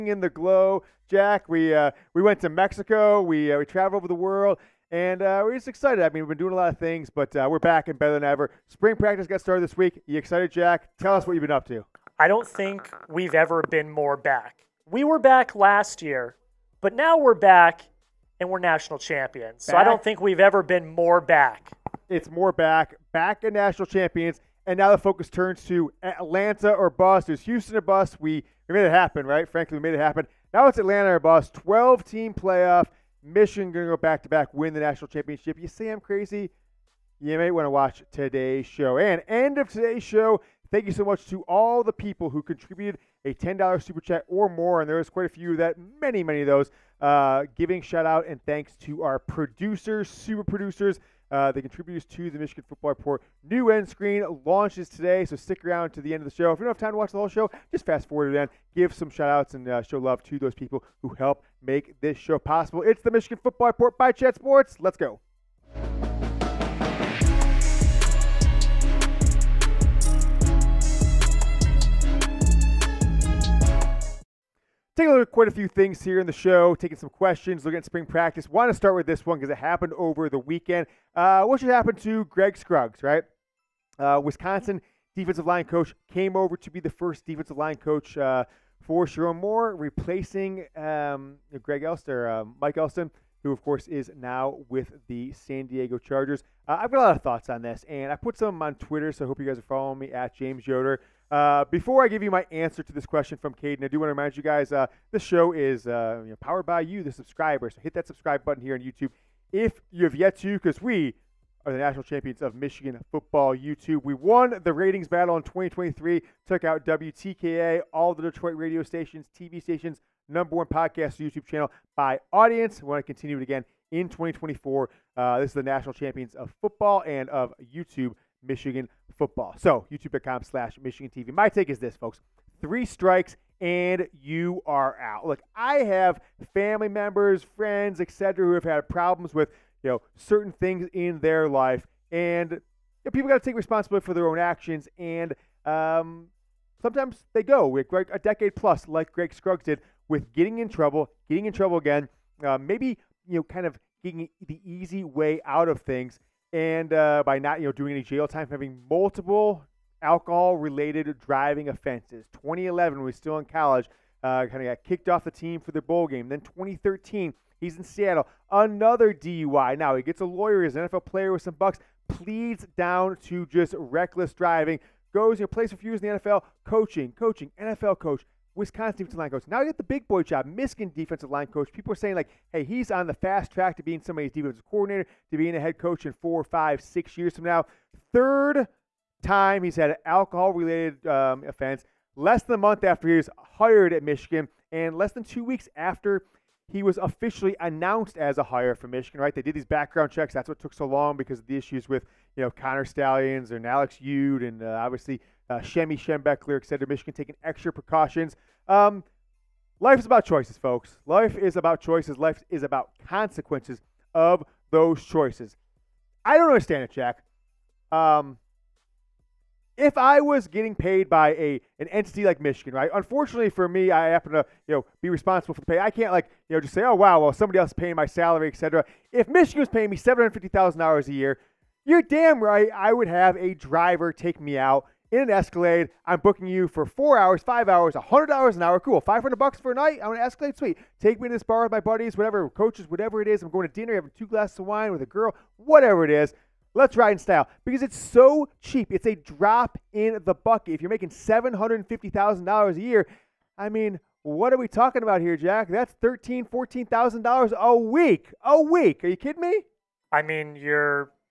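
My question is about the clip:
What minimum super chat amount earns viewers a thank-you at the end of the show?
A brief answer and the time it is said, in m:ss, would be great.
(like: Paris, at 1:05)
$10, at 0:43.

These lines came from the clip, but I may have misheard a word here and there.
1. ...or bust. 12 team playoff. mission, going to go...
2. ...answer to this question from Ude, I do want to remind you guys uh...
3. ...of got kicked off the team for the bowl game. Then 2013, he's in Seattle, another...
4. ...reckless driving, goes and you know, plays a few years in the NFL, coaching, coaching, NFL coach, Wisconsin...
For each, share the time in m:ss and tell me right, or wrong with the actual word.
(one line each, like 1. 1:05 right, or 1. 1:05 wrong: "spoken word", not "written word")
1. 0:31 right
2. 1:42 wrong: "Caden", not "Ude"
3. 2:44 right
4. 2:53 right.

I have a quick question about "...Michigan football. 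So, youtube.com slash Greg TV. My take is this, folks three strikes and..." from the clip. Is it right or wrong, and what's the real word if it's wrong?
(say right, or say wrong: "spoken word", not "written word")
wrong: "Michigan", not "Greg".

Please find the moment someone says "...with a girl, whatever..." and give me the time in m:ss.
4:04.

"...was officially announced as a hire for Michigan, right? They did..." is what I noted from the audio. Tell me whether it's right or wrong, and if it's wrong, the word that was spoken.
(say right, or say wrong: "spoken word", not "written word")
right.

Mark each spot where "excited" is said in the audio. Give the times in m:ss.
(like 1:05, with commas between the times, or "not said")
0:05, 0:10.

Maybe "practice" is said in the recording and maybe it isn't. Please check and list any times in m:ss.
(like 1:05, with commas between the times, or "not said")
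0:08, 1:18.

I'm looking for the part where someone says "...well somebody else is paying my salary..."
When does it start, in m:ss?
3:47.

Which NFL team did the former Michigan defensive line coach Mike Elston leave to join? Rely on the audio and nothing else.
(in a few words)
San Diego Chargers.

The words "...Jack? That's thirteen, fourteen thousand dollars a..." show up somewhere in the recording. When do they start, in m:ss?
4:15.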